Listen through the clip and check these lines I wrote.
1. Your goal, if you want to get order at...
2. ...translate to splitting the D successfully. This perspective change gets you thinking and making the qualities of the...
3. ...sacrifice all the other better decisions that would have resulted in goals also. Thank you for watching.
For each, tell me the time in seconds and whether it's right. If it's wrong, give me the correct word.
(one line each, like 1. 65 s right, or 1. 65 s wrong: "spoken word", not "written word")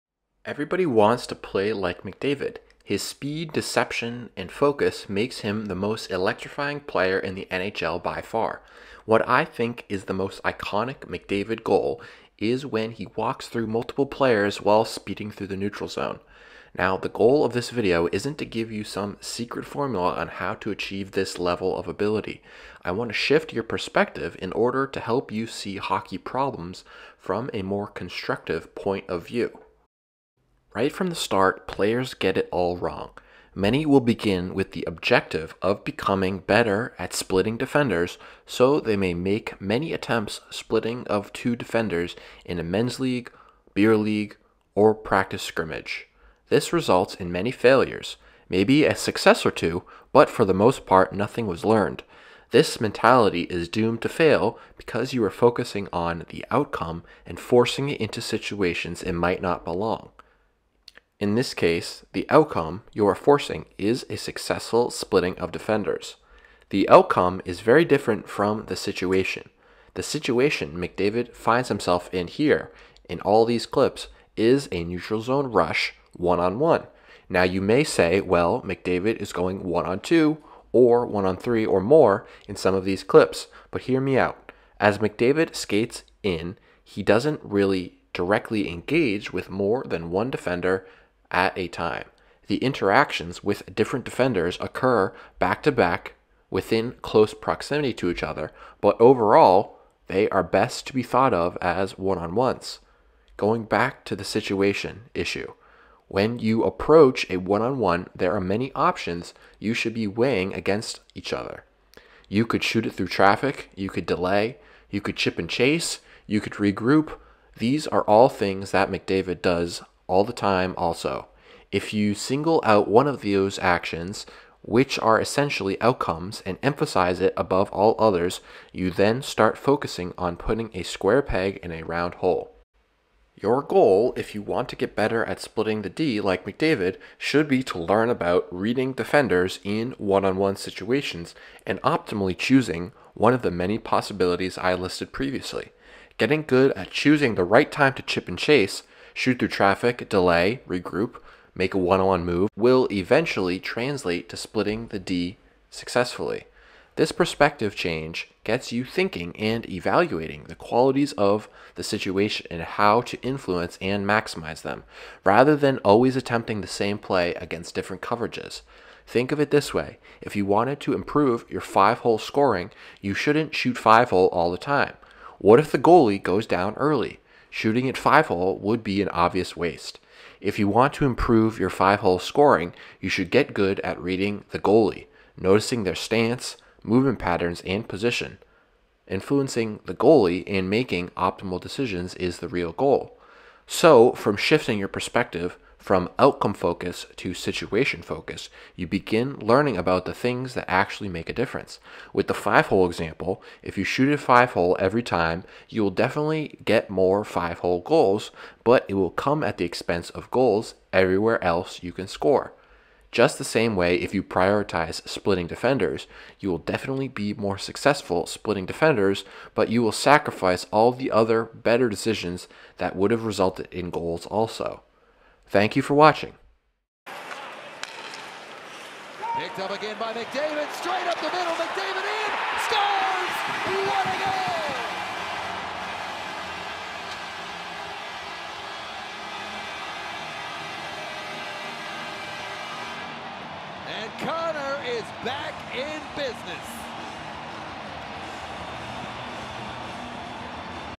1. 133 s wrong: "better", not "order"
2. 153 s wrong: "evaluating", not "making"
3. 219 s right.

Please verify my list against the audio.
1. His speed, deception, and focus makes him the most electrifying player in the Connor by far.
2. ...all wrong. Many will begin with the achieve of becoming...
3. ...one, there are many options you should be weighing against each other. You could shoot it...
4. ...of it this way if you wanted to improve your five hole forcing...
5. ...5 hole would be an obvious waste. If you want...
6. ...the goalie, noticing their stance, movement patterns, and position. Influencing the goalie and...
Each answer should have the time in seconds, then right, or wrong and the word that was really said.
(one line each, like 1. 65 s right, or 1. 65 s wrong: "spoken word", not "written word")
1. 2 s wrong: "NHL", not "Connor"
2. 32 s wrong: "objective", not "achieve"
3. 107 s right
4. 169 s wrong: "scoring", not "forcing"
5. 177 s right
6. 184 s right.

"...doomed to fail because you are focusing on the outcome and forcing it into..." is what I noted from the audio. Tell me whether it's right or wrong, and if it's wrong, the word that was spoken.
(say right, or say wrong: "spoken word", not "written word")
right.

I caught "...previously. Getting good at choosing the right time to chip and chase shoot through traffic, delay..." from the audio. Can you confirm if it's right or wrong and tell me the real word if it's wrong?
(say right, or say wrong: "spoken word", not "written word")
right.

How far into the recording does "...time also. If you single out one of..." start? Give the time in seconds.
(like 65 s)
120 s.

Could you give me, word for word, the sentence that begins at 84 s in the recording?
As McDavid skates in, he doesn't really directly engage with more than one defender at a time.